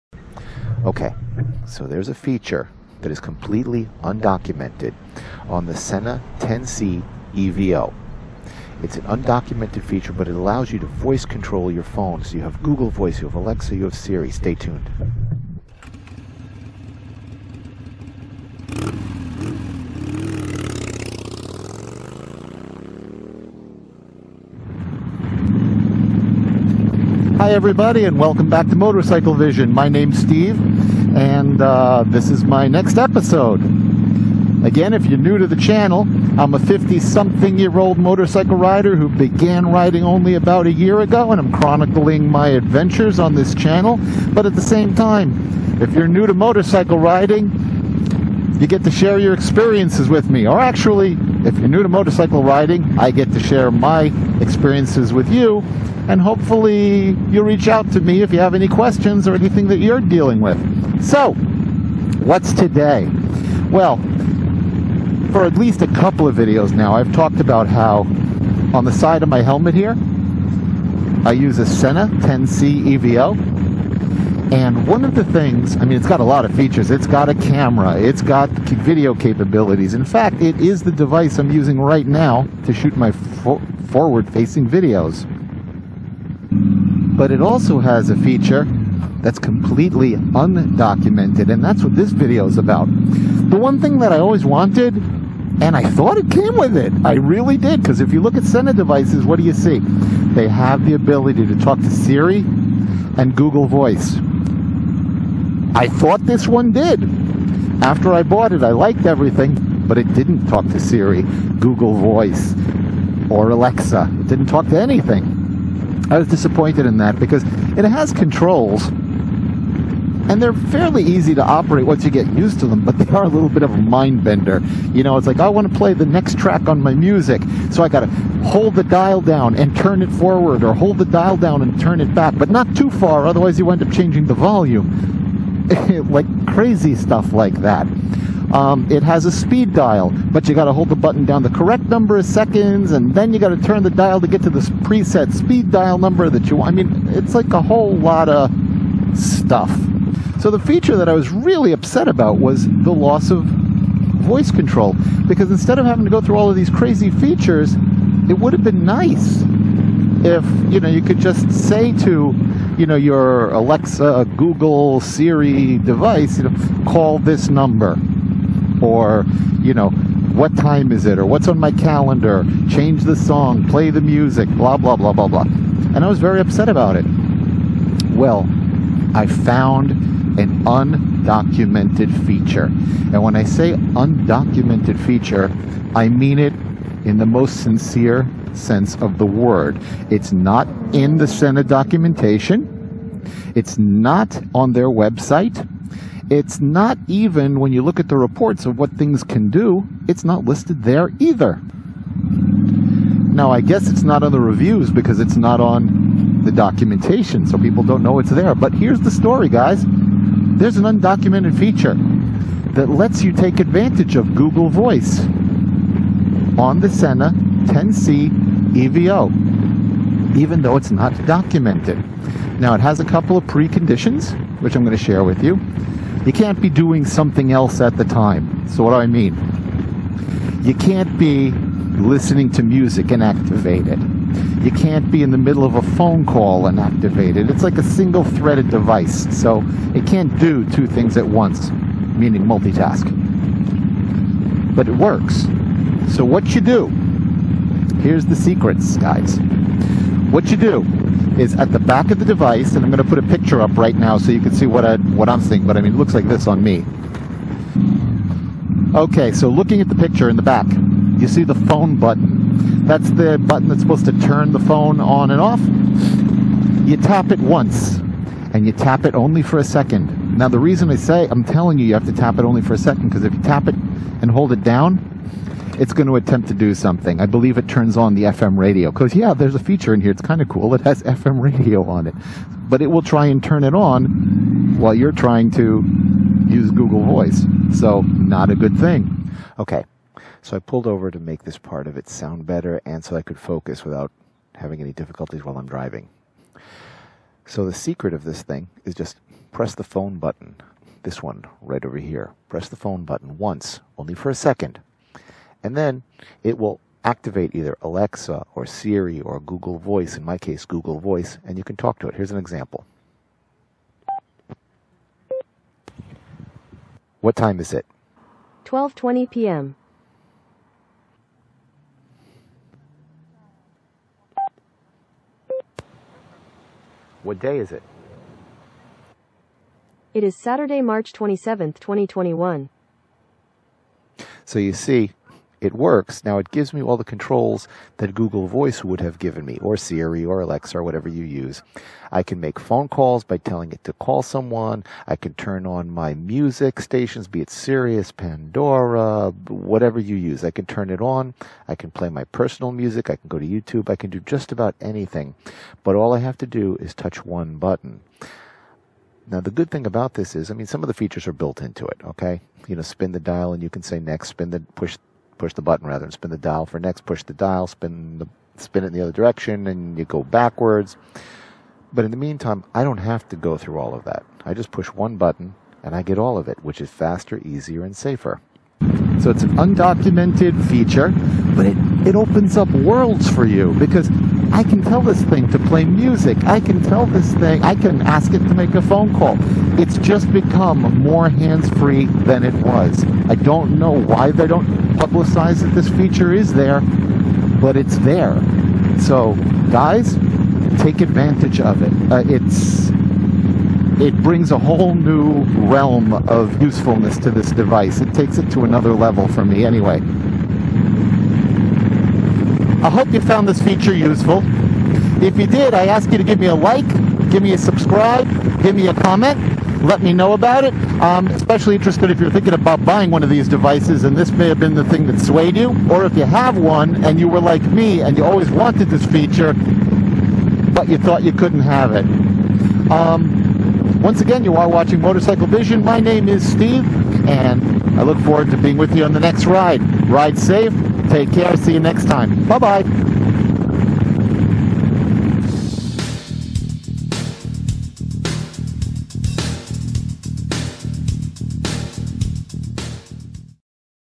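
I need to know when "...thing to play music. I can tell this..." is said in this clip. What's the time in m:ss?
6:25.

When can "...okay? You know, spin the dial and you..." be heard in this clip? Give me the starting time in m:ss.
6:02.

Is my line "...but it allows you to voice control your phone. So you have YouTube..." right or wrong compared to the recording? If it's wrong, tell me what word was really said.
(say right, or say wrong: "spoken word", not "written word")
wrong: "Google", not "YouTube".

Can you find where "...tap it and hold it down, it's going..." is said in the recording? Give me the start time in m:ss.
4:33.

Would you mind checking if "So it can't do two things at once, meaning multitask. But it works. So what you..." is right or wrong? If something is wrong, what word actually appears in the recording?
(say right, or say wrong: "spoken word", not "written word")
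right.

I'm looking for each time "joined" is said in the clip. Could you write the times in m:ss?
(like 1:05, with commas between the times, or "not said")
not said.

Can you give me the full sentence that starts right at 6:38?
So, guys, take advantage of it.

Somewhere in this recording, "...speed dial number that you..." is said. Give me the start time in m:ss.
2:25.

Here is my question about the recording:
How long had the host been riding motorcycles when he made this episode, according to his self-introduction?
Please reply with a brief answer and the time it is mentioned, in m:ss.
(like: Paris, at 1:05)
about a year, at 0:40.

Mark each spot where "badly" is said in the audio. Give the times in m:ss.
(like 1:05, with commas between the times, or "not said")
not said.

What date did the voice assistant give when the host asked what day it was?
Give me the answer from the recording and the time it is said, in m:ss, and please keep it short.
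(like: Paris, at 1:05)
Saturday, March 27th, 2021, at 5:30.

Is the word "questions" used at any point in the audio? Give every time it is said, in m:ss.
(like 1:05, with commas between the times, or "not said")
0:58.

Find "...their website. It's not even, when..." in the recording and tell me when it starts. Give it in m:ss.
3:14.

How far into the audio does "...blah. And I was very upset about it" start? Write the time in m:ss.
2:55.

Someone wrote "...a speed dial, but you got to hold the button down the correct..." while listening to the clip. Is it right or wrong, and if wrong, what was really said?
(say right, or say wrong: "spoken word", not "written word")
right.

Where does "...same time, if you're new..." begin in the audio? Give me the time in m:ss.
0:44.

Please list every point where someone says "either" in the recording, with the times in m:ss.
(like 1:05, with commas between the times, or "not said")
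3:21, 5:07.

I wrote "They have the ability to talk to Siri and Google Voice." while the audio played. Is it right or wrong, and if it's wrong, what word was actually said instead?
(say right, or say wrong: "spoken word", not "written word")
right.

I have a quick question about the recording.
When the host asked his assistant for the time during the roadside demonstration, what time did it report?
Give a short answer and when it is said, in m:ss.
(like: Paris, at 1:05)
12:20 p.m., at 5:18.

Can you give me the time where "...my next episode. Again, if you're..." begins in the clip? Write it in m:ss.
0:32.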